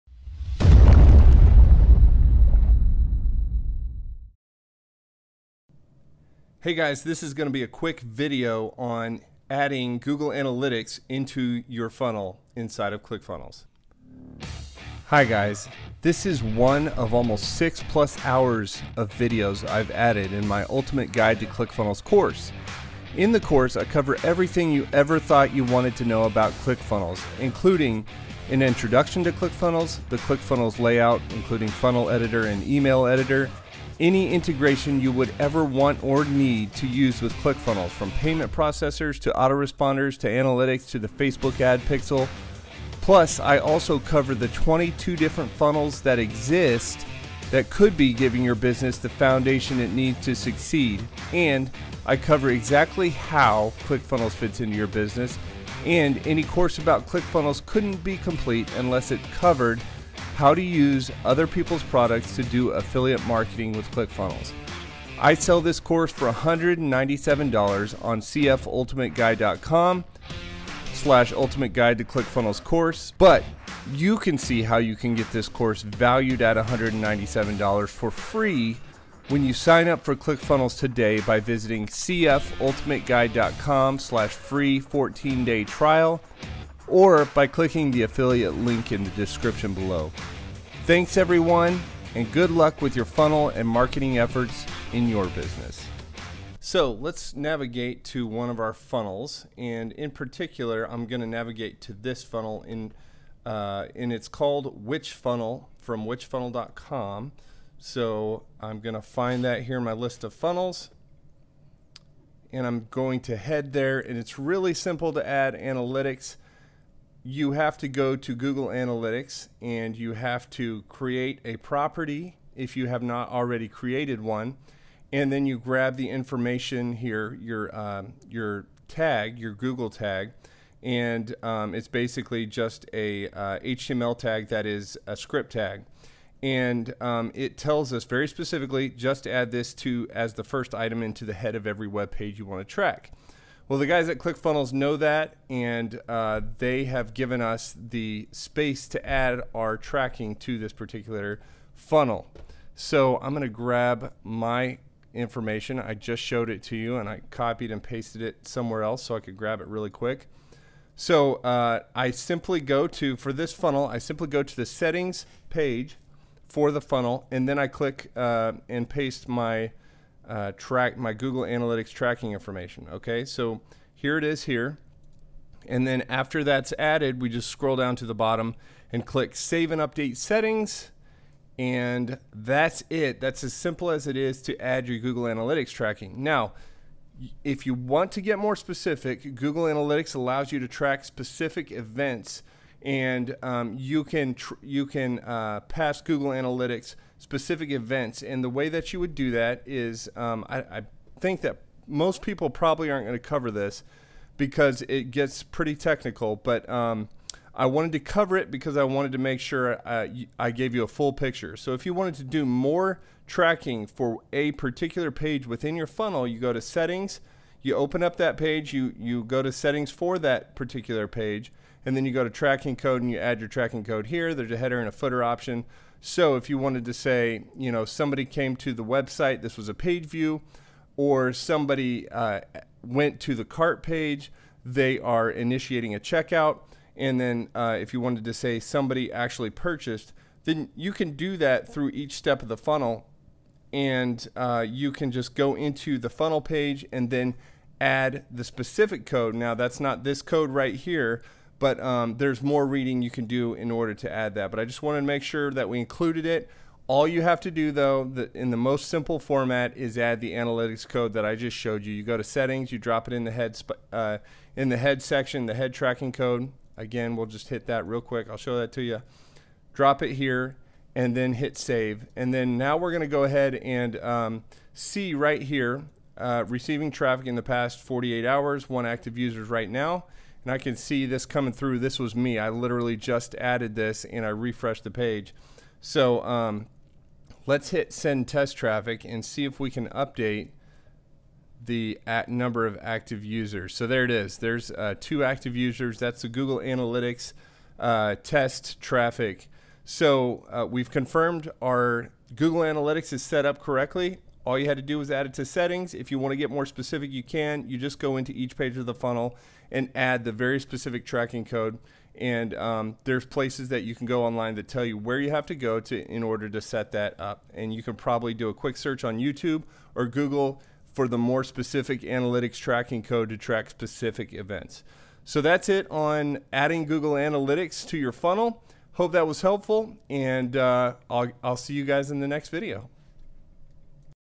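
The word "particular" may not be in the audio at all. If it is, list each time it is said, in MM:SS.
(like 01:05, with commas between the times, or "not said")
01:40, 02:30, 03:34, 03:40.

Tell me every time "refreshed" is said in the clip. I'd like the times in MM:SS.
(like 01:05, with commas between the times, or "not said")
04:44.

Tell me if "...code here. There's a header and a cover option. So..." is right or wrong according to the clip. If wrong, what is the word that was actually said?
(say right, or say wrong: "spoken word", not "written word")
wrong: "footer", not "cover".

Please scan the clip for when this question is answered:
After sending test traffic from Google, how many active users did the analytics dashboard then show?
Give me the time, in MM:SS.
04:54.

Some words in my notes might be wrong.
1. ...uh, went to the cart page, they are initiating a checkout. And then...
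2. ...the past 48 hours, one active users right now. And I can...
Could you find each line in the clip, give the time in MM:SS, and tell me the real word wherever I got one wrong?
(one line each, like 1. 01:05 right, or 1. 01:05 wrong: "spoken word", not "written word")
1. 03:52 right
2. 04:37 right.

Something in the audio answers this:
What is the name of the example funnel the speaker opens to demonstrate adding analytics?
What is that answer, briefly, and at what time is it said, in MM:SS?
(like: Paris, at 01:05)
Which Funnel, at 01:44.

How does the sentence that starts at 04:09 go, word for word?
Now that's not this code right here, but um, there's more reading you can do in order to add that.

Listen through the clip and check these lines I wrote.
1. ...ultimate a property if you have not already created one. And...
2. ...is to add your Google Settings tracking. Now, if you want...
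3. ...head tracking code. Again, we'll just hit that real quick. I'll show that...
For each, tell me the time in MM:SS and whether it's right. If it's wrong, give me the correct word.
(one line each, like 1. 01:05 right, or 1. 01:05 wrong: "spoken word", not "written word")
1. 02:00 wrong: "create", not "ultimate"
2. 03:04 wrong: "Analytics", not "Settings"
3. 04:25 right.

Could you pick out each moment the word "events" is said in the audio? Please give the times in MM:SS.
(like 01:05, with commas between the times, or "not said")
03:11, 03:17, 05:24.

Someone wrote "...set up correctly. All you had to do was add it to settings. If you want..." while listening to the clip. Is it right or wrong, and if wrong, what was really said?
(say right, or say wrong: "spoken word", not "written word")
right.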